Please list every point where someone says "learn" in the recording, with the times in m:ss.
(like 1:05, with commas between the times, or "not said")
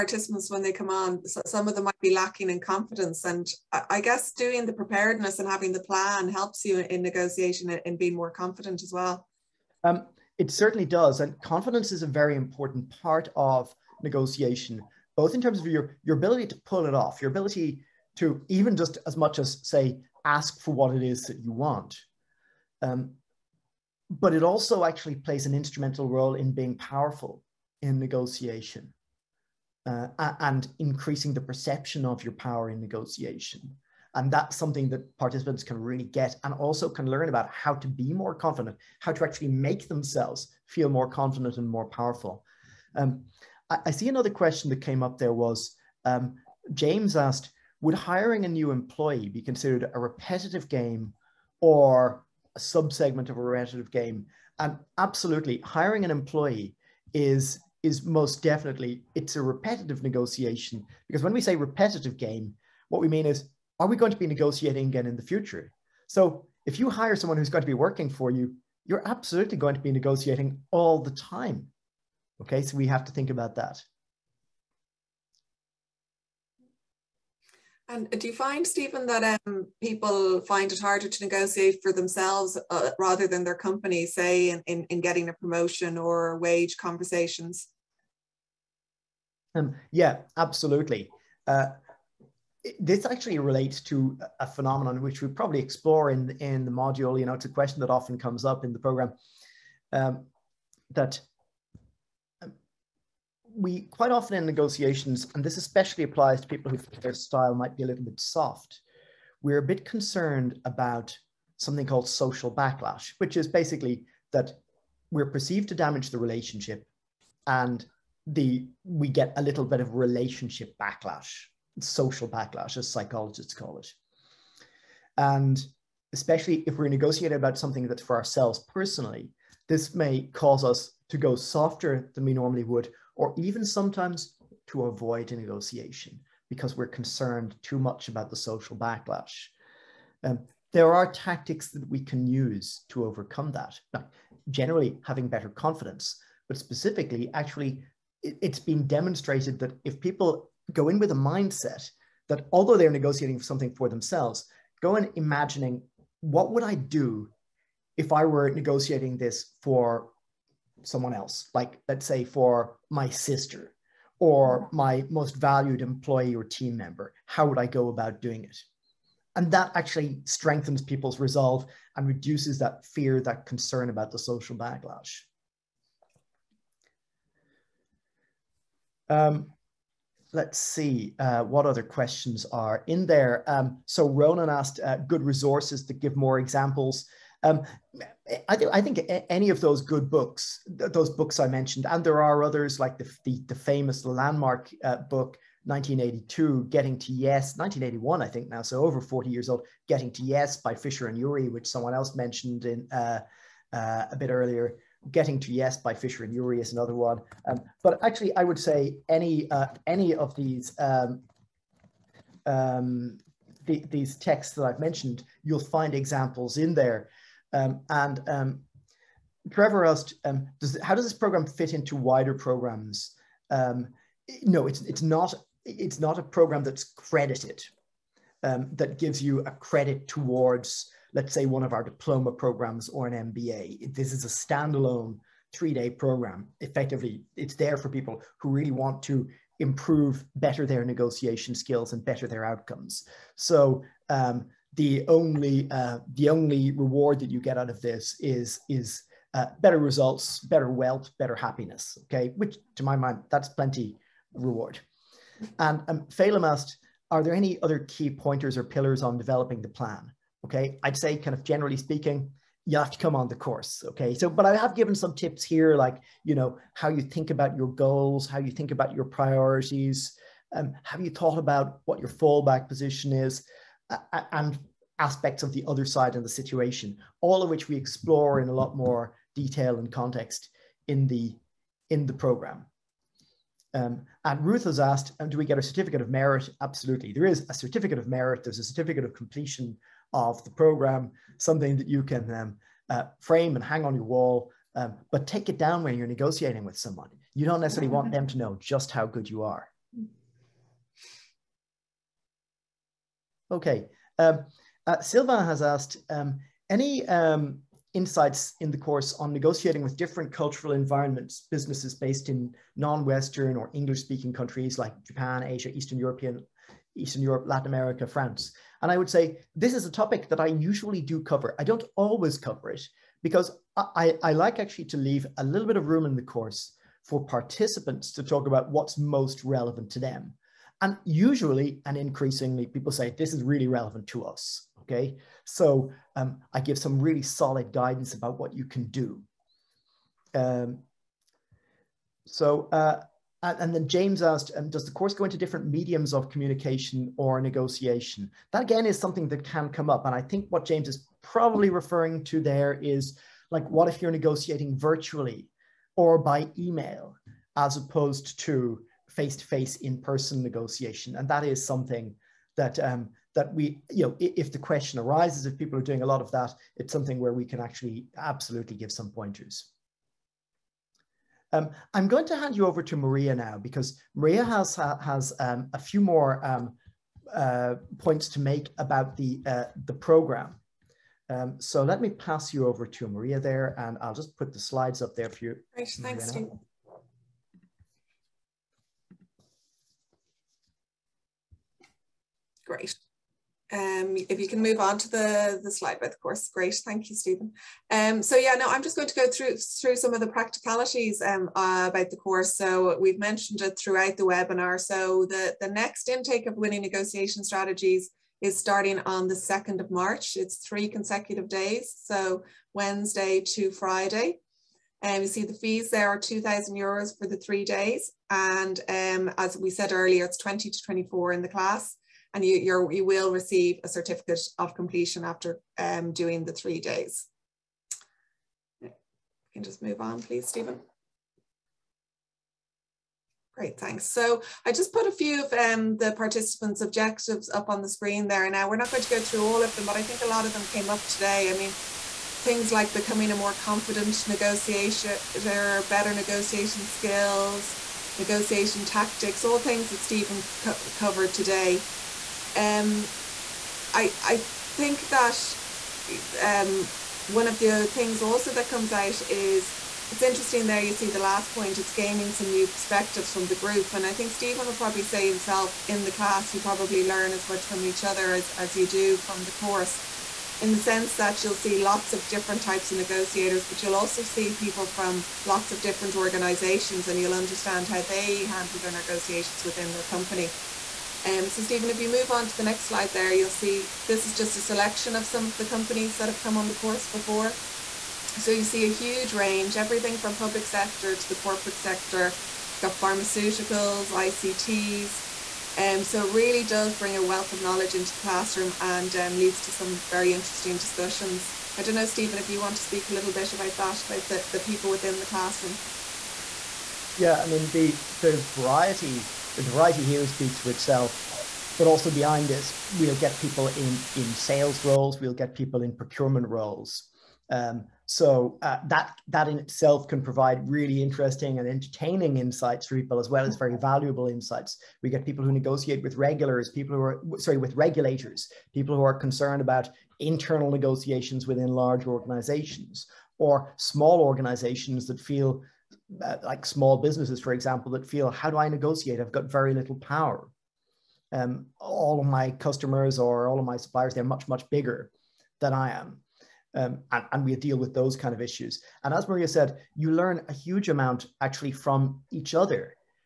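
0:37, 7:47, 9:10.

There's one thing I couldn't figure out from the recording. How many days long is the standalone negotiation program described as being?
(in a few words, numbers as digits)
3.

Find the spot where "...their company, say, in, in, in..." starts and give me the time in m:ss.
1:23.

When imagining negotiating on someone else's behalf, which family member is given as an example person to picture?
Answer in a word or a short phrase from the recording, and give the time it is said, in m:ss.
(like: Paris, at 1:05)
sister, at 2:42.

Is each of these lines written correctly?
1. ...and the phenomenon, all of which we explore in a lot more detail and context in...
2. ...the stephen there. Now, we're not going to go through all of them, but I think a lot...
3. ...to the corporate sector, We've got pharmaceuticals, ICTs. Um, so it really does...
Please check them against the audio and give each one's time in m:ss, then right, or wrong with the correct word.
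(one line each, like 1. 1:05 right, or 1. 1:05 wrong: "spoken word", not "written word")
1. 4:36 wrong: "situation", not "phenomenon"
2. 7:17 wrong: "screen", not "stephen"
3. 8:11 right.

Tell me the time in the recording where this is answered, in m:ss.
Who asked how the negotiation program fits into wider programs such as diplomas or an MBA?
3:39.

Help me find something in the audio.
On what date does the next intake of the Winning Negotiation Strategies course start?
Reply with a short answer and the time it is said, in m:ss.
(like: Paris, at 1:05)
2nd of March, at 6:49.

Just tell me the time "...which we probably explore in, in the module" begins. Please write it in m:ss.
1:35.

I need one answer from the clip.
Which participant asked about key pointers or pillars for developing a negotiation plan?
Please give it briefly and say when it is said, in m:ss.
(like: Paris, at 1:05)
Phelim, at 4:16.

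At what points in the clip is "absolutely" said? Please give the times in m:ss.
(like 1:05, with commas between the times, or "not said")
0:54, 1:09, 1:30, 4:46, 6:08.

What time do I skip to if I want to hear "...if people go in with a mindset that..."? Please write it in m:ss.
2:29.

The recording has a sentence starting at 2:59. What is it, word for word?
Um, let's see uh, what other questions are in there.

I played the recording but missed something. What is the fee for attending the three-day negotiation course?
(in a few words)
2,000 euros.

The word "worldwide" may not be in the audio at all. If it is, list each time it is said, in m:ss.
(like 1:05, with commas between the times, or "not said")
not said.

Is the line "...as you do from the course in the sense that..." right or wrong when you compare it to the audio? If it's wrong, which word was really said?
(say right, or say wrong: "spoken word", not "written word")
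right.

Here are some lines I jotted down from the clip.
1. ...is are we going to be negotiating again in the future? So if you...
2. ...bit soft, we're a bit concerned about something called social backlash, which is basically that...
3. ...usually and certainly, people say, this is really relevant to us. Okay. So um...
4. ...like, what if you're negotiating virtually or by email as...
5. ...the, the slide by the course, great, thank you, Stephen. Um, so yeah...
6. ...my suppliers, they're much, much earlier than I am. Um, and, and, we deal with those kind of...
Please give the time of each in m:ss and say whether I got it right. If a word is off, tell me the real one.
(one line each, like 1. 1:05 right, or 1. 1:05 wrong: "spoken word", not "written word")
1. 1:03 right
2. 1:48 right
3. 5:31 wrong: "increasingly", not "certainly"
4. 5:53 right
5. 6:35 right
6. 9:03 wrong: "bigger", not "earlier".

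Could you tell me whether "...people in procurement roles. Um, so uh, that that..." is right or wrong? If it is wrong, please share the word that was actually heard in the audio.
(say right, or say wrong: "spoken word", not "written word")
right.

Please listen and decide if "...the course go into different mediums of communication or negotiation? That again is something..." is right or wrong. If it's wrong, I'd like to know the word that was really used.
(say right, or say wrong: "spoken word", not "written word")
right.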